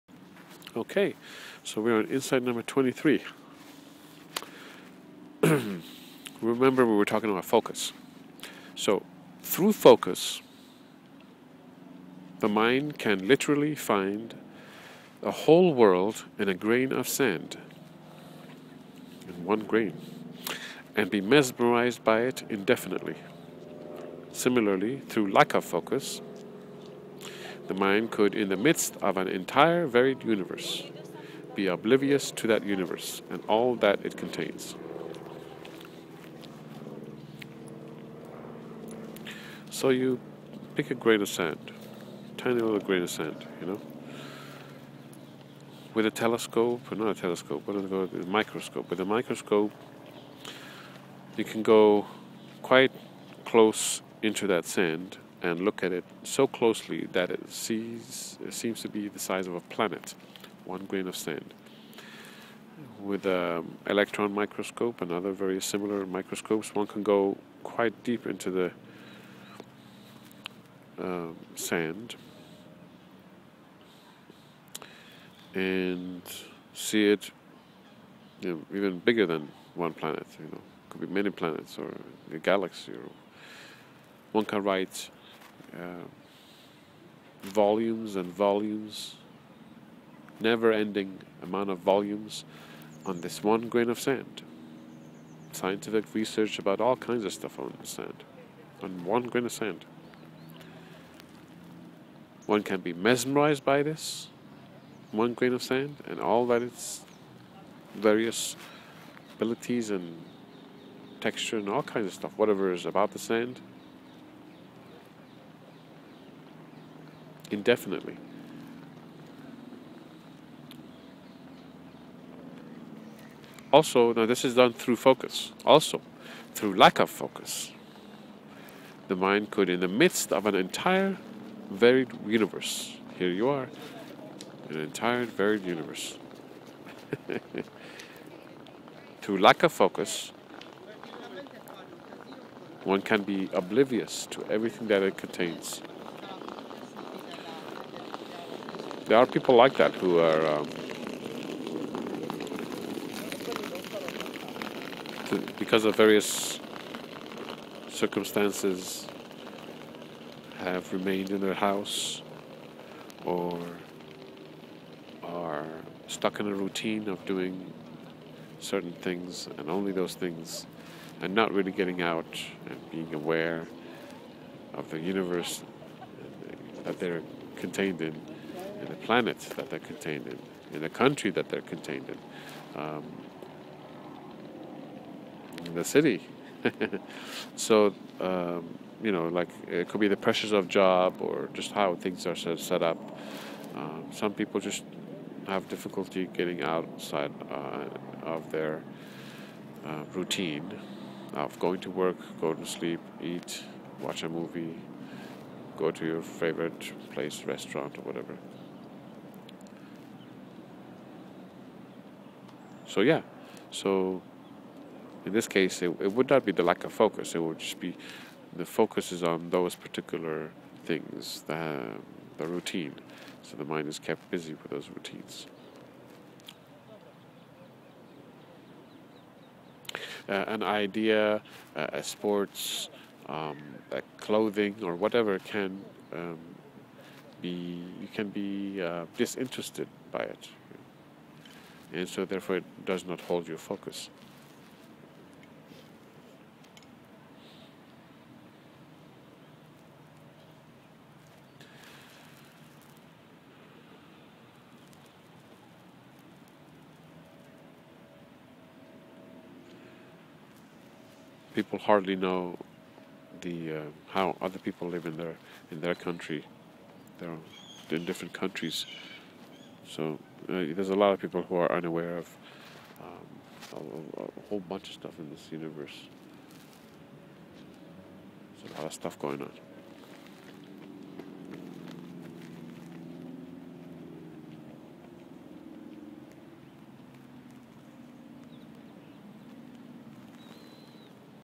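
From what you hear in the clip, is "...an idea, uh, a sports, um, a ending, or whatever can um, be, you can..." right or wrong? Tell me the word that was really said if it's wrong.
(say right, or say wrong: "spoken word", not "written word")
wrong: "clothing", not "ending".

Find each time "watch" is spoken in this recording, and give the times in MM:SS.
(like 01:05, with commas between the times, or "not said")
03:24.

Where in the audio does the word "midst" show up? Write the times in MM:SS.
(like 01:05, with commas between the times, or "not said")
00:28, 02:09.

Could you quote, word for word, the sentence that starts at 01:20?
You know, could be many planets or a galaxy.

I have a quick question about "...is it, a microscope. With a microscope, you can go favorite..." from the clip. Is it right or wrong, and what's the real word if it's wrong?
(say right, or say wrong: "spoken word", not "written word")
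wrong: "quite", not "favorite".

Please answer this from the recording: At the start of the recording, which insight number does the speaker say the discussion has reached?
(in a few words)
23.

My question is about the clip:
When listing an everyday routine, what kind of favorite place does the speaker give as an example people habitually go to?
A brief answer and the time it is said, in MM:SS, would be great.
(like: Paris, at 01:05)
restaurant, at 03:27.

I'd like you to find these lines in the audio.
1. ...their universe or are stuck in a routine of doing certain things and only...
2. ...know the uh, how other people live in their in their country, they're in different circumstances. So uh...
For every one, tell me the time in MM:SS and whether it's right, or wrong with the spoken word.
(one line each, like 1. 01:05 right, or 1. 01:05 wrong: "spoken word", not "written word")
1. 02:41 wrong: "house", not "universe"
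2. 04:22 wrong: "countries", not "circumstances".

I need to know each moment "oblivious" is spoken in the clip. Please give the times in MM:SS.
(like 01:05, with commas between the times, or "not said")
00:31, 02:23.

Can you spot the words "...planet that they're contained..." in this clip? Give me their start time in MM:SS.
02:58.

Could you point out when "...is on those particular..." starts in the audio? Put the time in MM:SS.
03:39.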